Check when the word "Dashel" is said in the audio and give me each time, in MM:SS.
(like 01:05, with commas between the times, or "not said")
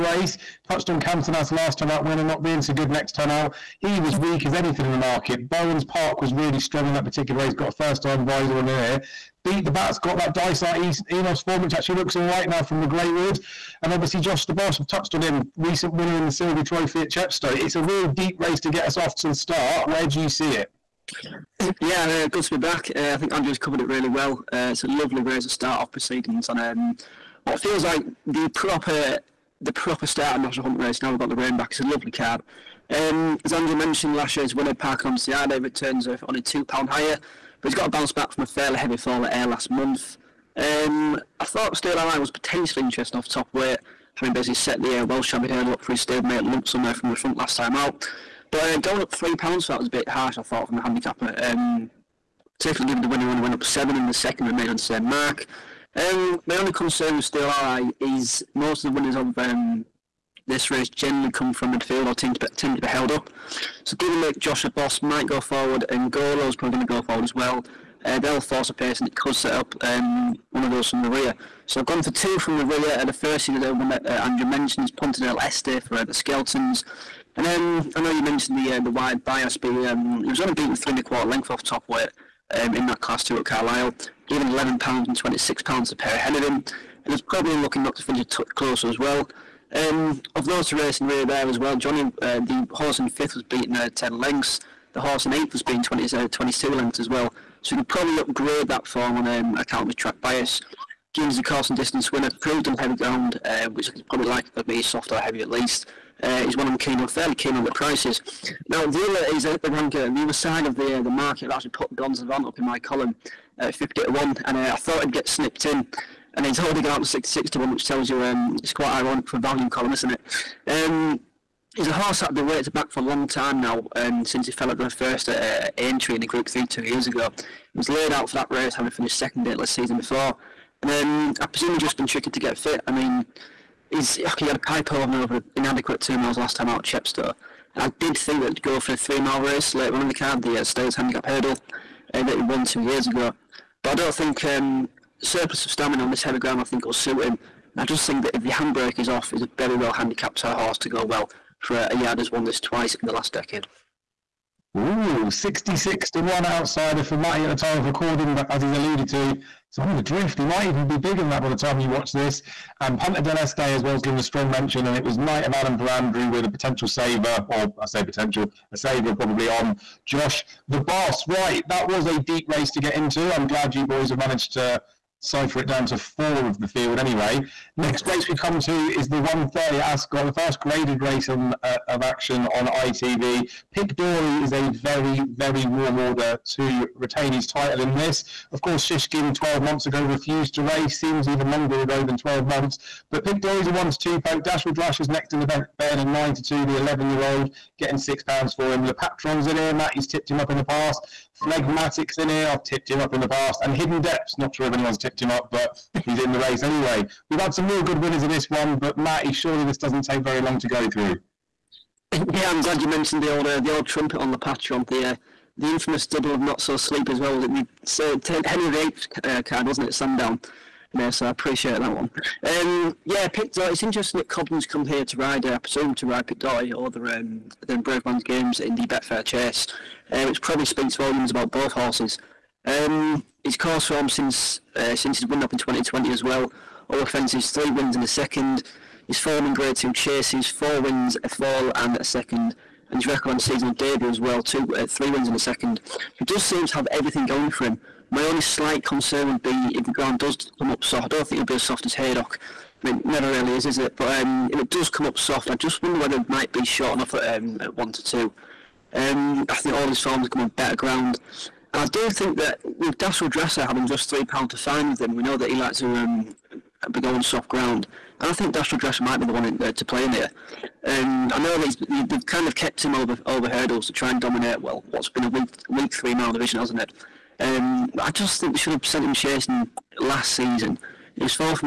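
03:14, 04:22, 04:28.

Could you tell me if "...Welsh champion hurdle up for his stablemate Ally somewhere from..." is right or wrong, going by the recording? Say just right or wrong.
wrong.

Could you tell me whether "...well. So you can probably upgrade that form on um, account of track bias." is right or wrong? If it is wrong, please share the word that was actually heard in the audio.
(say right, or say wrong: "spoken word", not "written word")
right.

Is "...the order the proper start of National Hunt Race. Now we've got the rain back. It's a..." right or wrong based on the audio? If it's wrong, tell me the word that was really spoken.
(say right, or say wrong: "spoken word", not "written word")
wrong: "proper", not "order".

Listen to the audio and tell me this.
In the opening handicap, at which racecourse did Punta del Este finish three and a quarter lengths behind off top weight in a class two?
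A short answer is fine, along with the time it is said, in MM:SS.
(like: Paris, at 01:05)
Carlisle, at 01:23.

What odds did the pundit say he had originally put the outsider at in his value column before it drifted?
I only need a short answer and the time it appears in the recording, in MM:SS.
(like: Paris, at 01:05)
50 to 1, at 01:53.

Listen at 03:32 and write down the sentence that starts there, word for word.
Yeah, I'm glad you mentioned the old uh, the old trumpet on the Patron.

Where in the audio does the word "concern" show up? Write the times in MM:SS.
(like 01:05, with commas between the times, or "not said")
00:56, 04:08.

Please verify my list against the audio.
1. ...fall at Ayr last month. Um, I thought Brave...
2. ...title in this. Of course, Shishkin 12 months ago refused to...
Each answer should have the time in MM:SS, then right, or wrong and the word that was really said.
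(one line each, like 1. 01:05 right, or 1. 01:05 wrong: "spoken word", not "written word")
1. 00:38 wrong: "Steel", not "Brave"
2. 03:07 right.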